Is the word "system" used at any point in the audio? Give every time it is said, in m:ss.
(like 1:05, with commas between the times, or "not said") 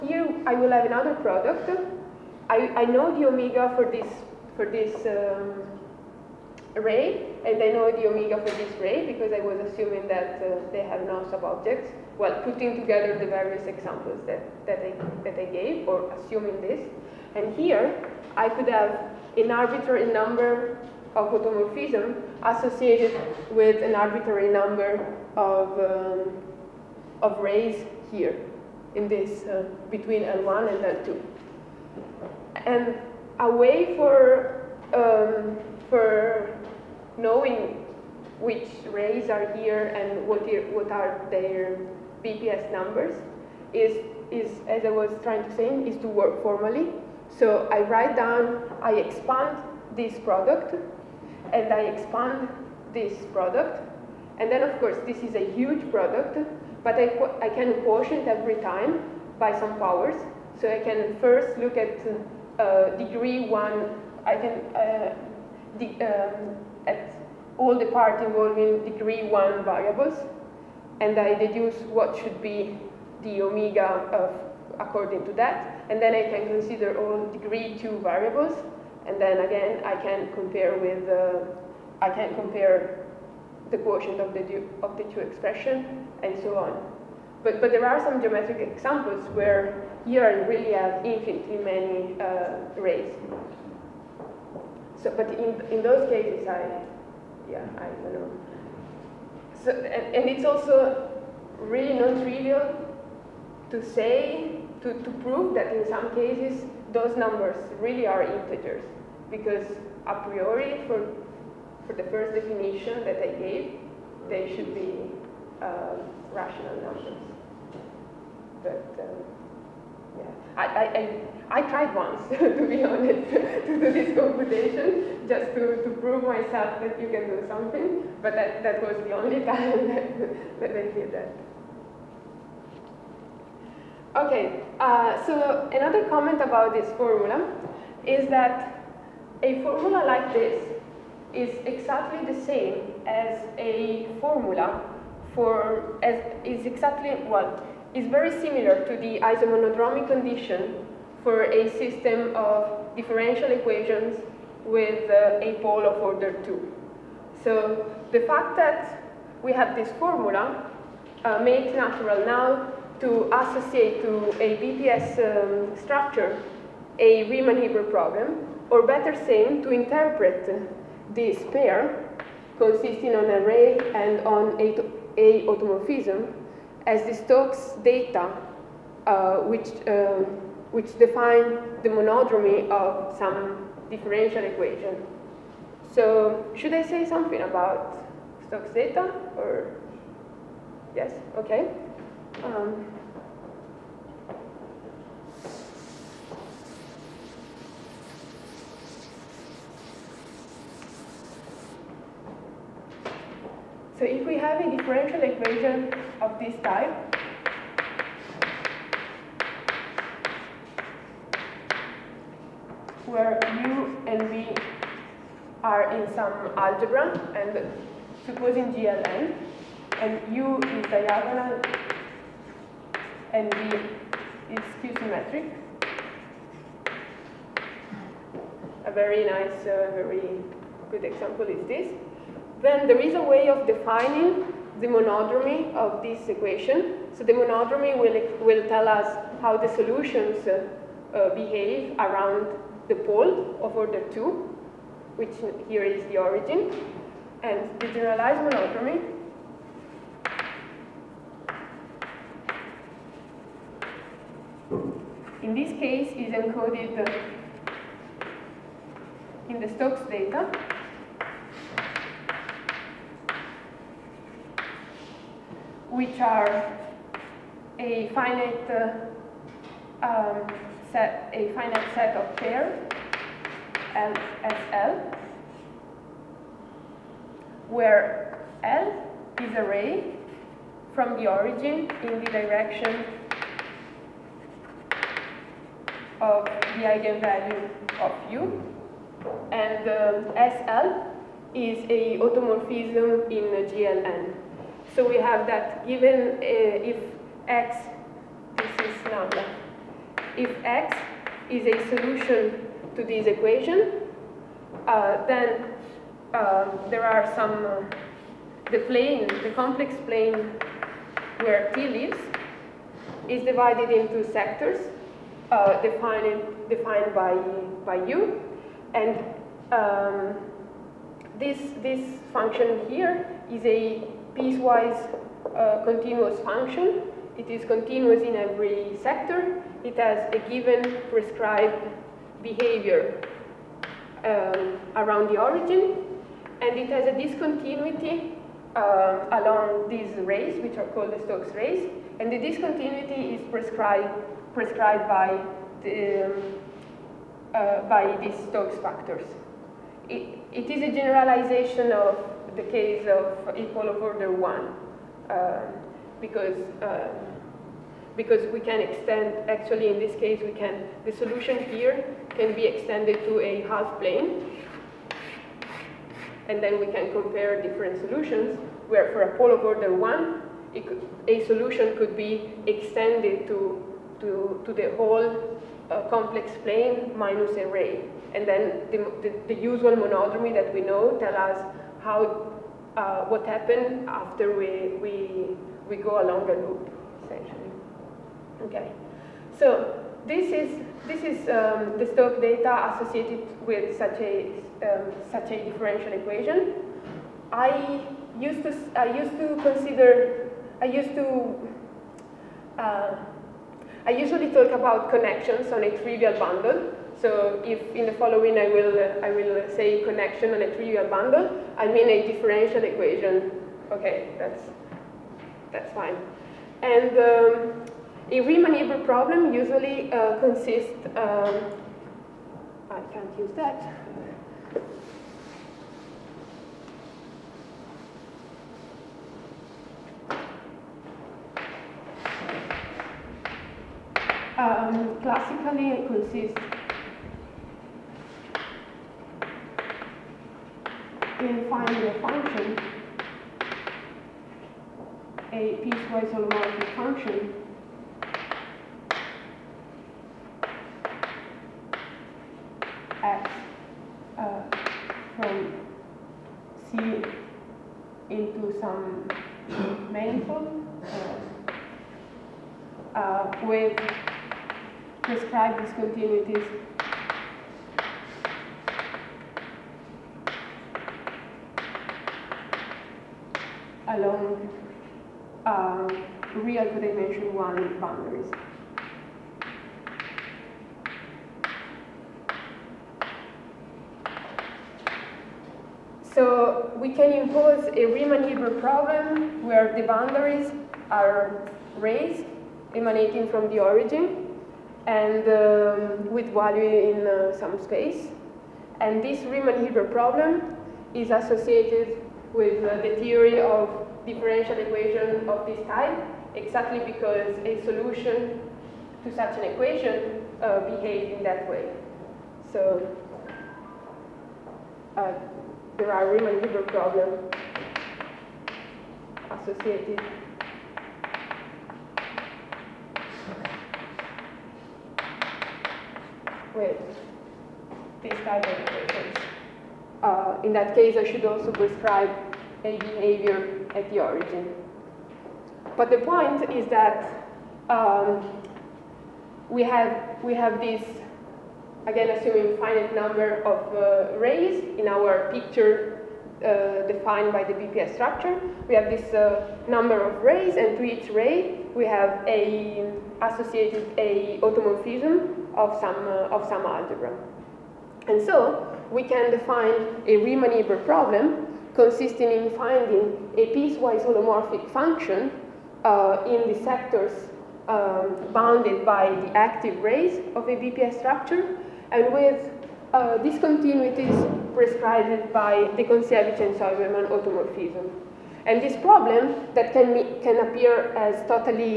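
2:31.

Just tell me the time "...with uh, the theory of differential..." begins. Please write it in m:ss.
8:22.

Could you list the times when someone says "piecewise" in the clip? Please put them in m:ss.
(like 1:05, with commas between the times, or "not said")
5:24, 7:25, 9:23.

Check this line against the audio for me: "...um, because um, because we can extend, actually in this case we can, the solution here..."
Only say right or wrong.
right.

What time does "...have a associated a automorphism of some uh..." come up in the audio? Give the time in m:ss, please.
9:12.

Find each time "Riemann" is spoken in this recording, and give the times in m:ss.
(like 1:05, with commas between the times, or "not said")
2:47, 6:58, 8:08, 8:19, 8:36, 9:20.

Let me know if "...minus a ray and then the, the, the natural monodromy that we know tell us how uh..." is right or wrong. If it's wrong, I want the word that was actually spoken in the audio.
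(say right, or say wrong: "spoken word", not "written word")
wrong: "usual", not "natural".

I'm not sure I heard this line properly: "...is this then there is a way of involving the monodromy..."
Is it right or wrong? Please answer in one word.
wrong.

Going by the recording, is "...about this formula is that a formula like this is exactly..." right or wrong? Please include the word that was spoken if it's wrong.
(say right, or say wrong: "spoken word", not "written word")
right.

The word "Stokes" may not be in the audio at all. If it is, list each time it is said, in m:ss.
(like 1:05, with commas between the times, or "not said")
2:57, 3:08, 4:19, 5:41, 5:48, 6:32.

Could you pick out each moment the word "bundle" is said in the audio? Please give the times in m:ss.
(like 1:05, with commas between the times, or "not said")
6:46, 6:51.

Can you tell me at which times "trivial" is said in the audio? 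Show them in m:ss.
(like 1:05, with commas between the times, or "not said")
1:41, 6:46, 6:50.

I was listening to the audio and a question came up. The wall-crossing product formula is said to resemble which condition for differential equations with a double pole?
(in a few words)
isomonodromic condition.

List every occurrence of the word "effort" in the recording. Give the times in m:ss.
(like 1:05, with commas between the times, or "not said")
not said.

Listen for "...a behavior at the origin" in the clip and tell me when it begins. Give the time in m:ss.
8:52.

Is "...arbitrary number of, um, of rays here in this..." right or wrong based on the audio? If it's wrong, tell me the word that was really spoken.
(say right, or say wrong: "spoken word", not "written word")
right.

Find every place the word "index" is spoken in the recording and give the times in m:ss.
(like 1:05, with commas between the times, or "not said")
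not said.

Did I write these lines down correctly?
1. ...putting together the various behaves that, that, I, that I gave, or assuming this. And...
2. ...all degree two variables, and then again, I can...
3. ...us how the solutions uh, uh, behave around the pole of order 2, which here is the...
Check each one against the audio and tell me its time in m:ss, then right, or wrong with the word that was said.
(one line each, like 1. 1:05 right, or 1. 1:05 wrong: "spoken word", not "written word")
1. 0:12 wrong: "examples", not "behaves"
2. 1:16 right
3. 3:58 right.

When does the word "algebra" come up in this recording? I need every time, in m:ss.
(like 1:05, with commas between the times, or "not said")
3:36, 9:16.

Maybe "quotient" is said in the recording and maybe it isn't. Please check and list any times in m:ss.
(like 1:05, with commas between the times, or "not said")
0:57, 1:23.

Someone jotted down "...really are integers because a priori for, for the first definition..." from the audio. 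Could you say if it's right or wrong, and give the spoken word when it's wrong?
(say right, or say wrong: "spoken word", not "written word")
right.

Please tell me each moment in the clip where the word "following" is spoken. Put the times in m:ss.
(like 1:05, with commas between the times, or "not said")
6:48.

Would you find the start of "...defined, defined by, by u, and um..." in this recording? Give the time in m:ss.
5:15.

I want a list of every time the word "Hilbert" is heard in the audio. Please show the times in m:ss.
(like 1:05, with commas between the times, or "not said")
2:47, 6:58, 8:08, 8:19, 8:36, 9:20.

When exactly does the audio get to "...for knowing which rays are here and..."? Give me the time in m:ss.
0:35.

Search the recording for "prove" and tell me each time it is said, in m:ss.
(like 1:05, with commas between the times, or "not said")
1:45, 2:06.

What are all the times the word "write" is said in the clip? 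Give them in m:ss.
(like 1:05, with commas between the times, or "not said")
0:47.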